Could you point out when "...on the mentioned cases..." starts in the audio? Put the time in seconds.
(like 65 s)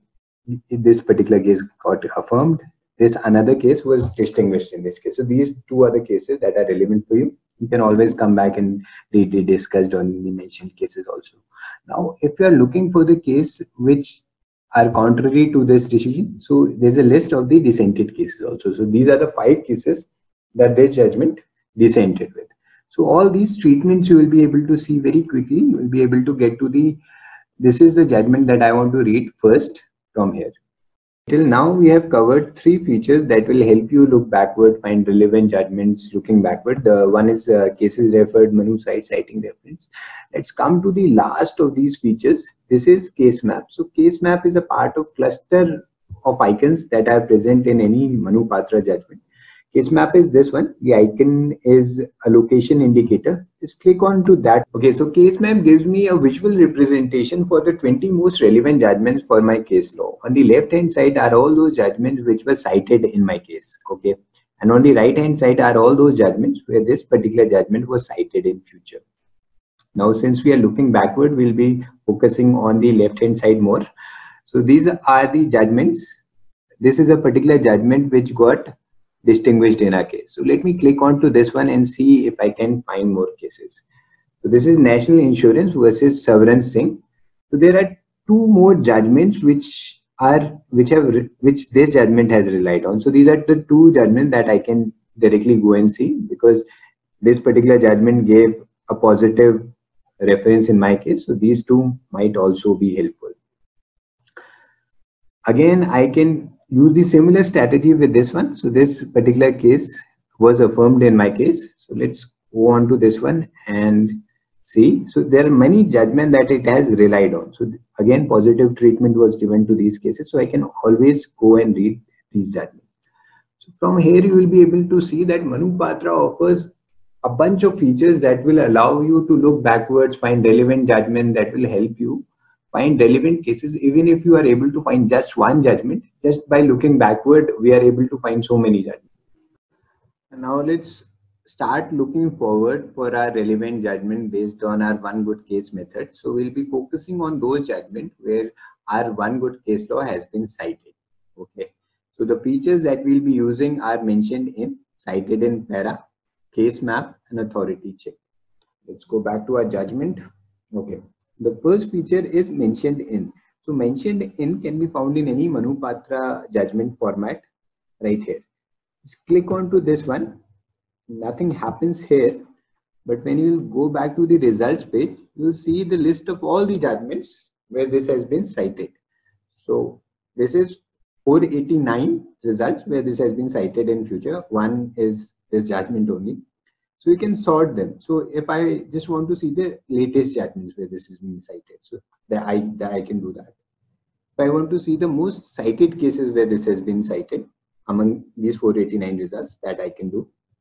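9 s.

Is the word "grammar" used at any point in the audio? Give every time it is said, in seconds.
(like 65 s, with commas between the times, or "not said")
not said.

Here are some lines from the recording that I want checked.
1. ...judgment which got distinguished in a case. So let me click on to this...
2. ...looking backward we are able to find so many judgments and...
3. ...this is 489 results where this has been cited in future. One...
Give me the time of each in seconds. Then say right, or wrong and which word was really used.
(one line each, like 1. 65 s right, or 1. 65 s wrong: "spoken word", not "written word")
1. 77 s right
2. 136 s right
3. 180 s right.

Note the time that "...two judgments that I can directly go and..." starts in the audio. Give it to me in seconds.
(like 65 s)
93 s.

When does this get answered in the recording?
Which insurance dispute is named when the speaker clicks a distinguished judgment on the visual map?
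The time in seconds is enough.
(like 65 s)
84 s.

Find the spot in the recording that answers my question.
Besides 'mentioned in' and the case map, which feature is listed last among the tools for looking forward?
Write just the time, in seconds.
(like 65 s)
157 s.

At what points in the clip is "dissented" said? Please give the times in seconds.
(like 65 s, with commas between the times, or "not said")
17 s, 21 s.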